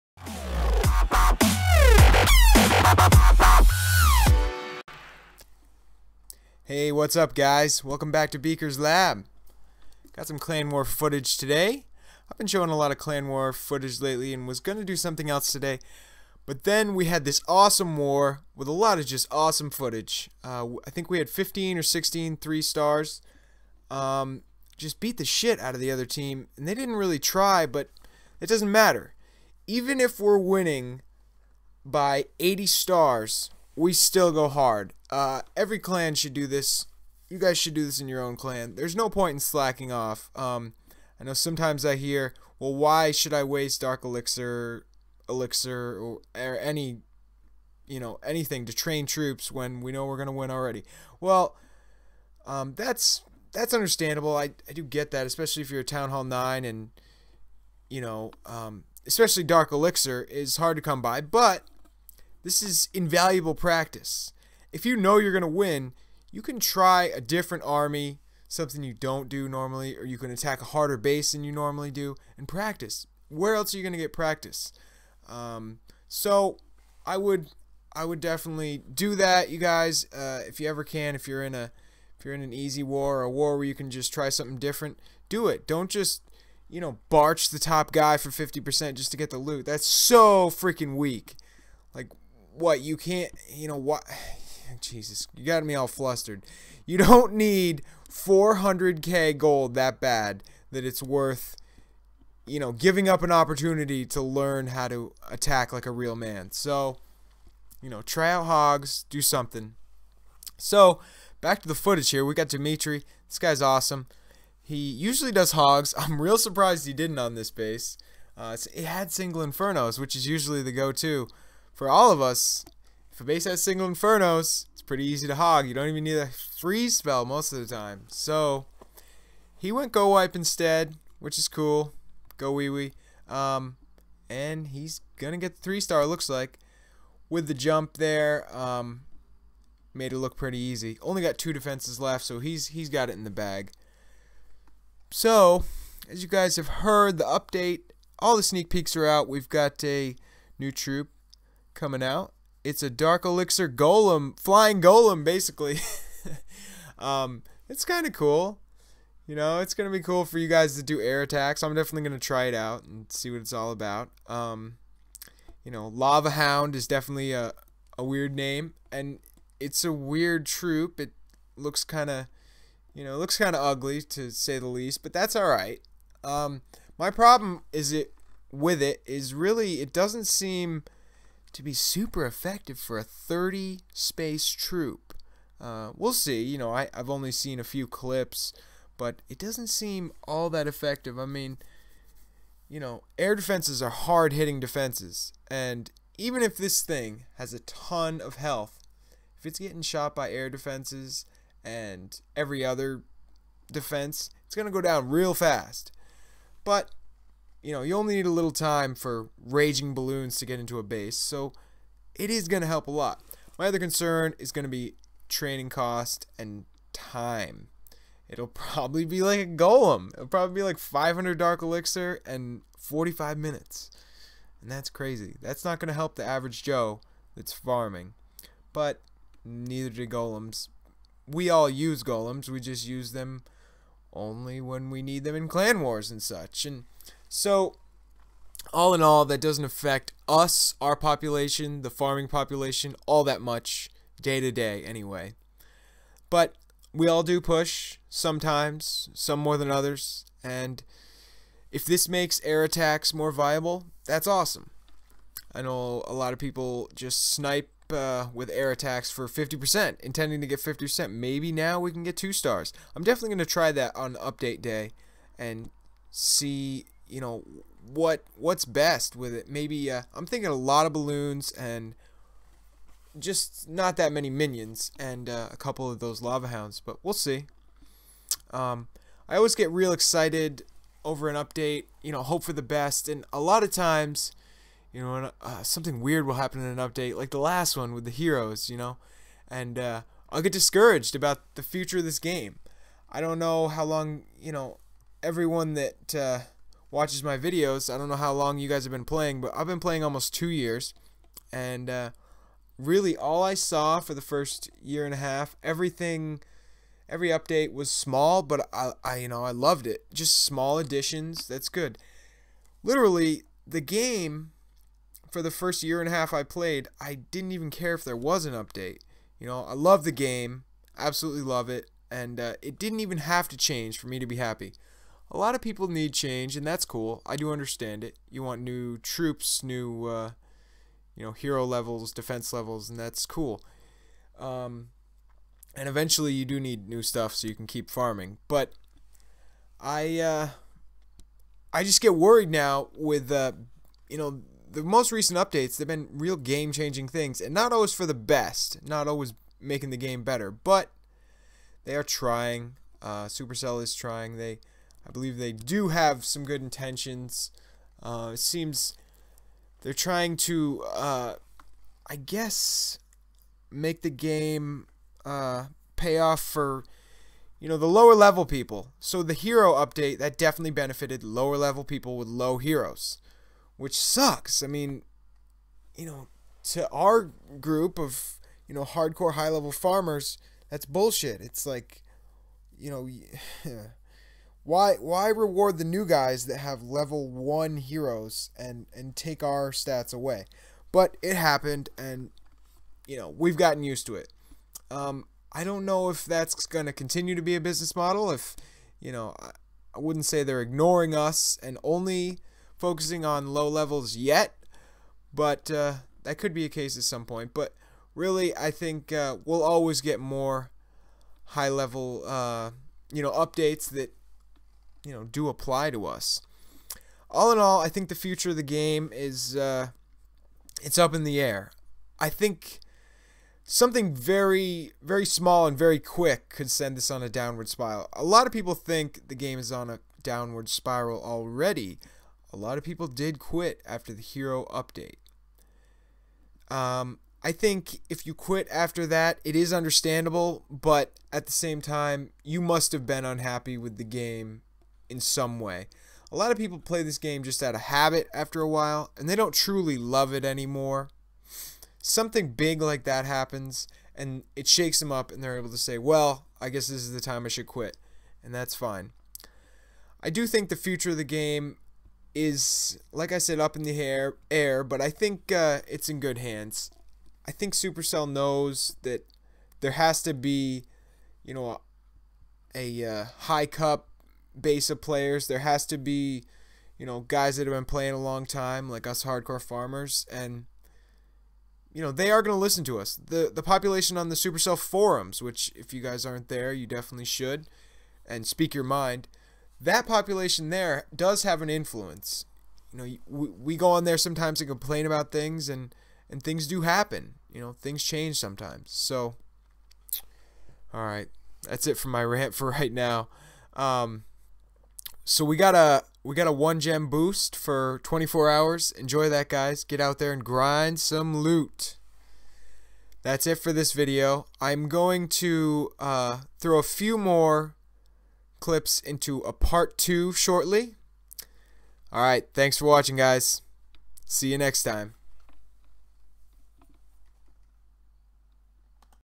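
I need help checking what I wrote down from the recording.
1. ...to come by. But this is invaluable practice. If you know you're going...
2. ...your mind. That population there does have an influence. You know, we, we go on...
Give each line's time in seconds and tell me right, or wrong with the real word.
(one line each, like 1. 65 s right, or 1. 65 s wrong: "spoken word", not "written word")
1. 60 s right
2. 488 s right.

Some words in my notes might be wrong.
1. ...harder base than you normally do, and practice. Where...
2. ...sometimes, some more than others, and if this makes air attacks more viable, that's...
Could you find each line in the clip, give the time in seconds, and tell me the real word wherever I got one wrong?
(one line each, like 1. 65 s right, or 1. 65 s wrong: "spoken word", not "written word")
1. 70 s right
2. 248 s right.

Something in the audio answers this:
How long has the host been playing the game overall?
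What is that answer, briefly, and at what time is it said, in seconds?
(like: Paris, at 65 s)
almost two years, at 300 s.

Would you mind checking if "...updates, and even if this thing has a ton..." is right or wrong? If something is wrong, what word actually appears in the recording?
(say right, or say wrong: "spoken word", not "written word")
wrong: "defenses", not "updates".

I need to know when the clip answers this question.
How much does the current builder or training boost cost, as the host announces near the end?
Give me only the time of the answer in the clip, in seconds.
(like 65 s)
506 s.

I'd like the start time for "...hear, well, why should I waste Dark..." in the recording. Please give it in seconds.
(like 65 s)
41 s.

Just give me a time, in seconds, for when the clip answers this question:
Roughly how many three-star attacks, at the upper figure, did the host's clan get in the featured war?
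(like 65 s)
21 s.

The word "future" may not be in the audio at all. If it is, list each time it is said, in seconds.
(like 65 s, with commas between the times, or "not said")
291 s, 418 s, 460 s.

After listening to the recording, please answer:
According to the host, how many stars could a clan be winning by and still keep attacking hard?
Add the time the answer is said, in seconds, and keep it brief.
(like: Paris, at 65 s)
80, at 32 s.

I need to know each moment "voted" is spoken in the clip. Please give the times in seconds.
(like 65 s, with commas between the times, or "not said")
not said.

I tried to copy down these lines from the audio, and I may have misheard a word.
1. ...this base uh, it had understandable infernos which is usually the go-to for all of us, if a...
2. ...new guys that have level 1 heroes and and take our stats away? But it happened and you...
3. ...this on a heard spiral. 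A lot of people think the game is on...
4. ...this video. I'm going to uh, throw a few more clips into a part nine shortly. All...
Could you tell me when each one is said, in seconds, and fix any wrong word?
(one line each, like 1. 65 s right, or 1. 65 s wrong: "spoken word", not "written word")
1. 117 s wrong: "single", not "understandable"
2. 385 s right
3. 426 s wrong: "downward", not "heard"
4. 513 s wrong: "two", not "nine".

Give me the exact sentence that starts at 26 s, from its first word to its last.
And they didn't really try, but it doesn't matter.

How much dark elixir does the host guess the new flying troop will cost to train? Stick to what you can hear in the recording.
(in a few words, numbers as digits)
500.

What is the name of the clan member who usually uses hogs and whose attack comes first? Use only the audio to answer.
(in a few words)
Dimitri.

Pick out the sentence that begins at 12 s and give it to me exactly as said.
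I've been showing a lot of Clan War footage lately and was going to do something else today.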